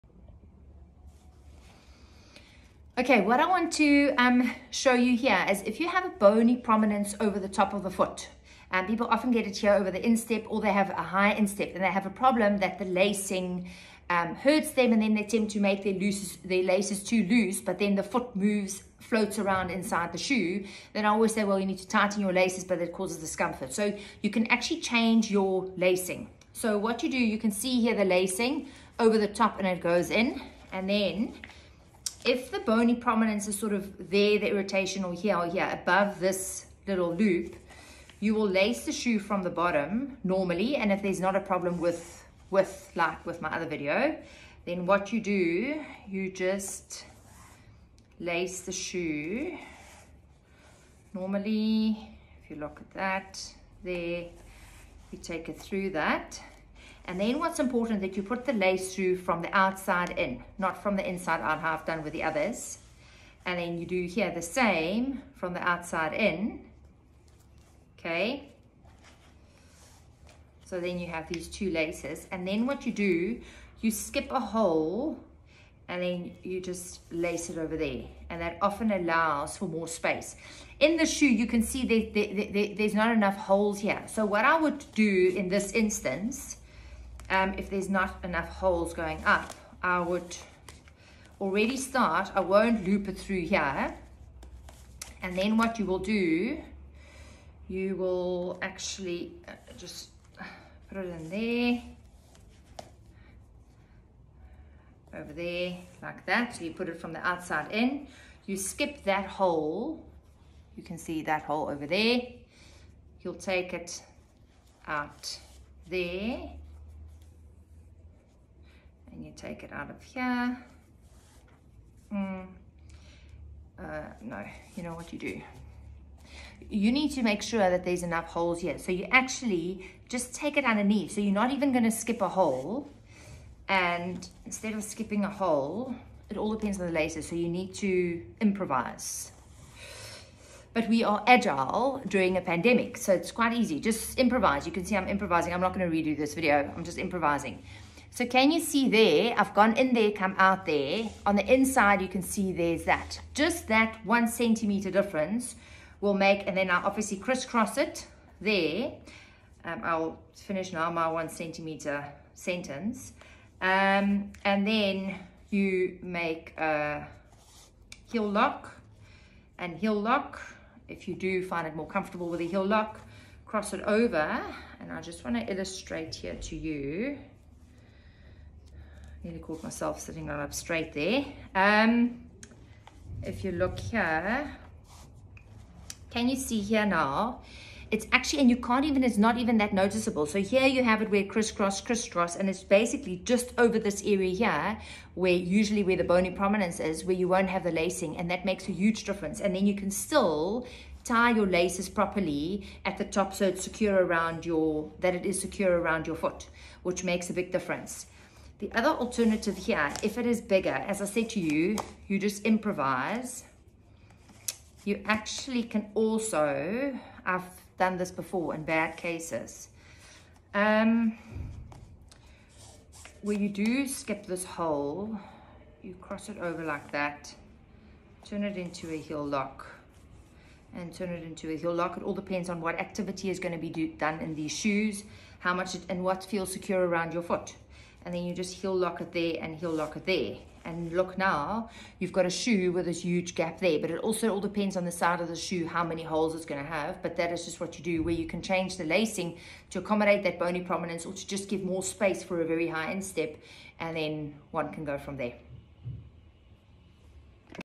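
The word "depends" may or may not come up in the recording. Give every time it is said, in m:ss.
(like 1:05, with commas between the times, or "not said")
2:16, 3:52, 4:04.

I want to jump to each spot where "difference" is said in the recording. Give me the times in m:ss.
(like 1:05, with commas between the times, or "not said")
2:34, 3:19, 3:27.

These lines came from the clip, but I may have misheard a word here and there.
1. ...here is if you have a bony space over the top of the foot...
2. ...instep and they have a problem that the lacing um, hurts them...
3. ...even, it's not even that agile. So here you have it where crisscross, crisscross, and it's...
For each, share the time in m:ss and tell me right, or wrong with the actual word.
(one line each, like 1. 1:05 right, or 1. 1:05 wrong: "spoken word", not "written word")
1. 0:05 wrong: "prominence", not "space"
2. 0:11 right
3. 3:08 wrong: "noticeable", not "agile".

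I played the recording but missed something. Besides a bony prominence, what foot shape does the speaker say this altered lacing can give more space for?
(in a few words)
A very high instep.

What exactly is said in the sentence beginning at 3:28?
The other alternative here, if it is bigger, as I said to you, you just improvise.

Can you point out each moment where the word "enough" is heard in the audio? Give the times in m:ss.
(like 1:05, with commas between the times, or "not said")
1:23, 1:28, 2:08.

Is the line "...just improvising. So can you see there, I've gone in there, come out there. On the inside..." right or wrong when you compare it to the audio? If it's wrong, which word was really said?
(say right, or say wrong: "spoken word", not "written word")
right.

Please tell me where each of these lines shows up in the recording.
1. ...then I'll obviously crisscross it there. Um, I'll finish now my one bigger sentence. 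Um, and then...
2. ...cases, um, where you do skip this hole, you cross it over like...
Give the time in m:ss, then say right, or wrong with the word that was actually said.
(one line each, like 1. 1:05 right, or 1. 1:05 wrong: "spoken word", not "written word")
1. 2:36 wrong: "centimeter", not "bigger"
2. 3:38 right.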